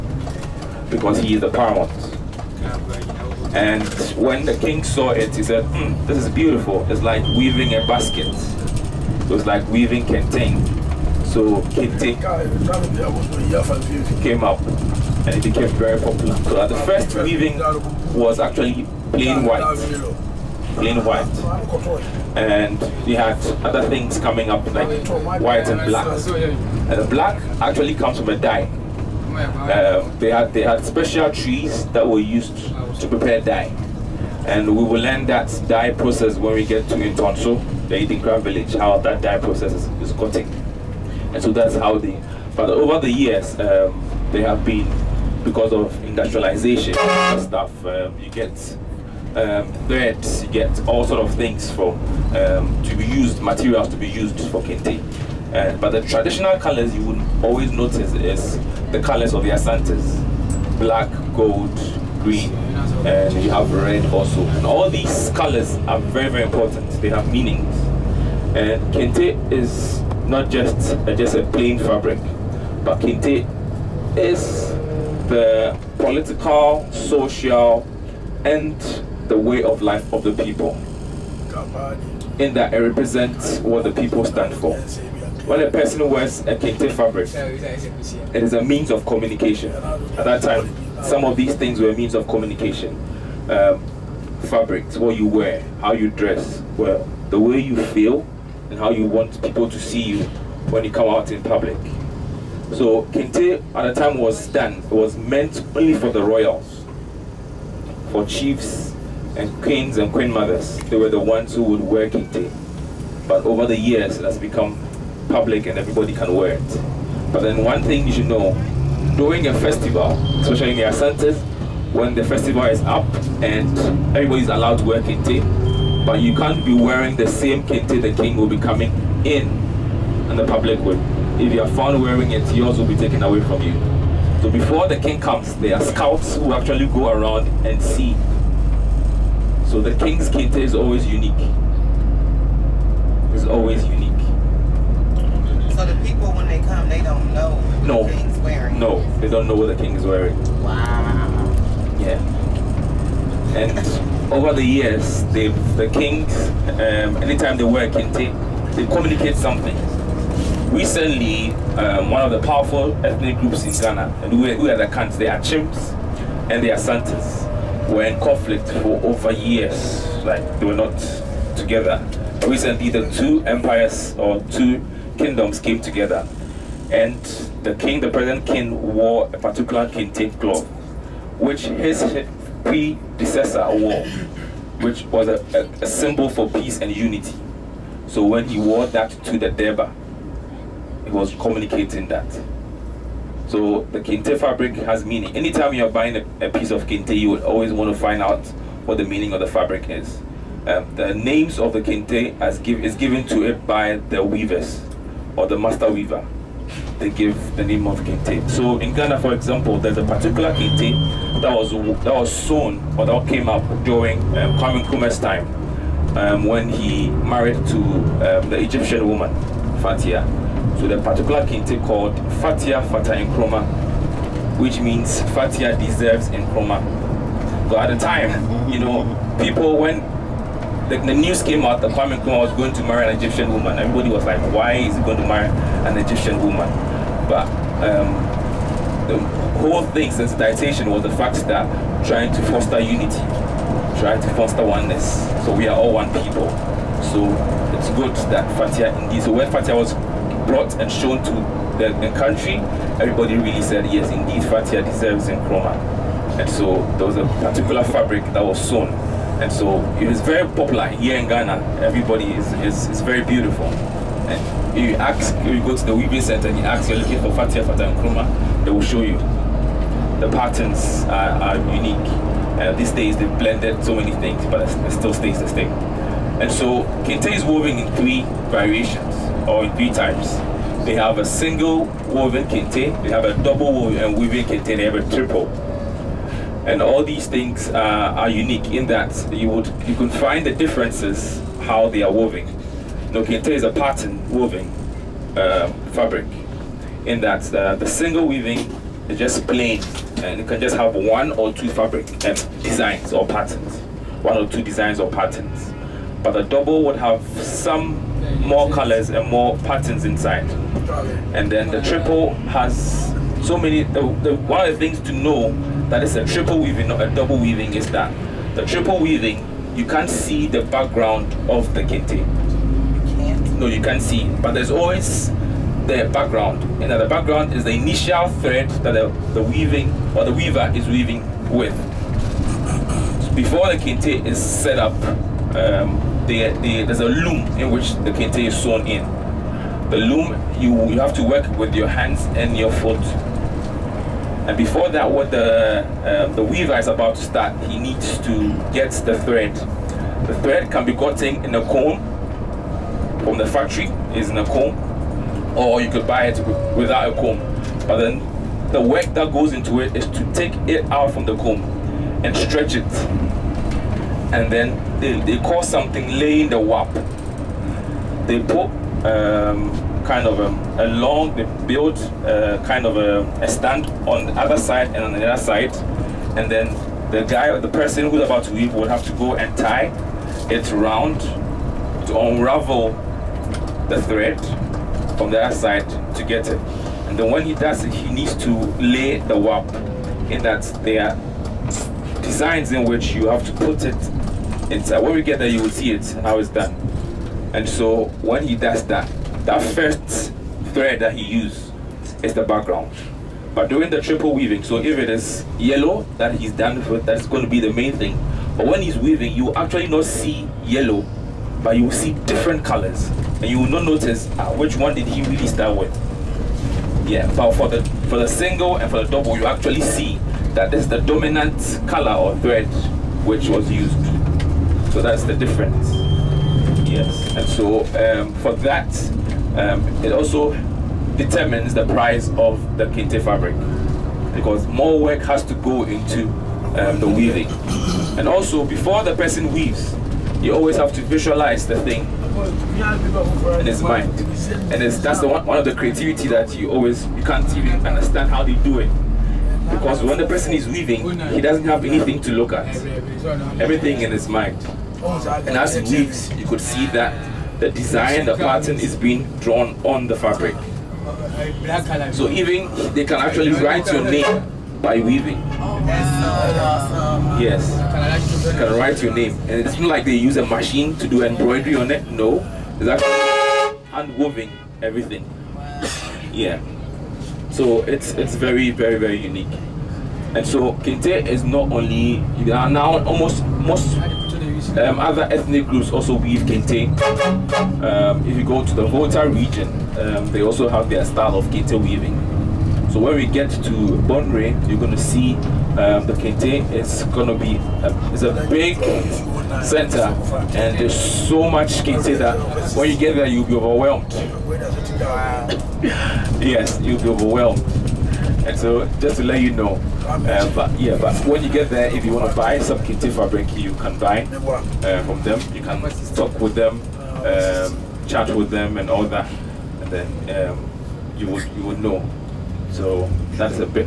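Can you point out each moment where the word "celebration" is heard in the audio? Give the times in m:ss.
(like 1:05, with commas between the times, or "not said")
not said.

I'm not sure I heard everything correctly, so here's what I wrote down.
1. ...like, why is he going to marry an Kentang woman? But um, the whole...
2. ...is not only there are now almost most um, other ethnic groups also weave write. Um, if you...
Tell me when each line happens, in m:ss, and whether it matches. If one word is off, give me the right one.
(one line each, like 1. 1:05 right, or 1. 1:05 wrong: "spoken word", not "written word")
1. 3:54 wrong: "Egyptian", not "Kentang"
2. 8:01 wrong: "kente", not "write".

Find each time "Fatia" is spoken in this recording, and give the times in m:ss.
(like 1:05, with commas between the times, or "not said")
3:42, 4:27.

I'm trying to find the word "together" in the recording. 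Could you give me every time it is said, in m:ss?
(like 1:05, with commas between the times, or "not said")
2:51, 2:55.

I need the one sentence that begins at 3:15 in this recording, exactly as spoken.
Anytime you're buying a, a piece of kente, you would always want to find out what the meaning of the fabric is.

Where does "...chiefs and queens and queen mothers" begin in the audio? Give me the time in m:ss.
1:48.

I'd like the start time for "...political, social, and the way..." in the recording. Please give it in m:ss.
1:15.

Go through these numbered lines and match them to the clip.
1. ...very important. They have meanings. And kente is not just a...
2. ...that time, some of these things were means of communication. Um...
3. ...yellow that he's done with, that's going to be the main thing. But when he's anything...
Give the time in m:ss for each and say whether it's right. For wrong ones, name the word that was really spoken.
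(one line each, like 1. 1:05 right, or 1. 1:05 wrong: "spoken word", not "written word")
1. 1:06 right
2. 1:30 right
3. 6:45 wrong: "weaving", not "anything".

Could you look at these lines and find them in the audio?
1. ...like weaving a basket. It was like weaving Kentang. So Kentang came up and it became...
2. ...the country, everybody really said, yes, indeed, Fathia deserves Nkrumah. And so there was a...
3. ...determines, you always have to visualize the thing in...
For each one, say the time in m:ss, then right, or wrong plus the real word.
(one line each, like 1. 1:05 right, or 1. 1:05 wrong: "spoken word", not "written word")
1. 0:07 right
2. 4:11 right
3. 7:19 wrong: "weaves", not "determines".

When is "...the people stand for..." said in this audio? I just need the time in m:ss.
1:23.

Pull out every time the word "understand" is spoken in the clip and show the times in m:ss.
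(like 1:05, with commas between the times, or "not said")
7:27.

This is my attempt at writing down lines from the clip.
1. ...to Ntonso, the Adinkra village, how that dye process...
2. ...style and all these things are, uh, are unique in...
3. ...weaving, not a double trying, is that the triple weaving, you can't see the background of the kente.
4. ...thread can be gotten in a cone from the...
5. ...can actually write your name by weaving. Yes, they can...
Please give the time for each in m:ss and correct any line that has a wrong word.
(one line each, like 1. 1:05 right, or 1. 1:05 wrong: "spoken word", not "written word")
1. 0:36 right
2. 4:45 wrong: "triple", not "style"
3. 5:16 wrong: "weaving", not "trying"
4. 5:50 right
5. 7:43 right.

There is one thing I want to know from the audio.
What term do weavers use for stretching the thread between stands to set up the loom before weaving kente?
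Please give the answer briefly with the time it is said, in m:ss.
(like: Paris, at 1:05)
Laying the warp, at 6:06.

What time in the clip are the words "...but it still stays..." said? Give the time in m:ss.
4:34.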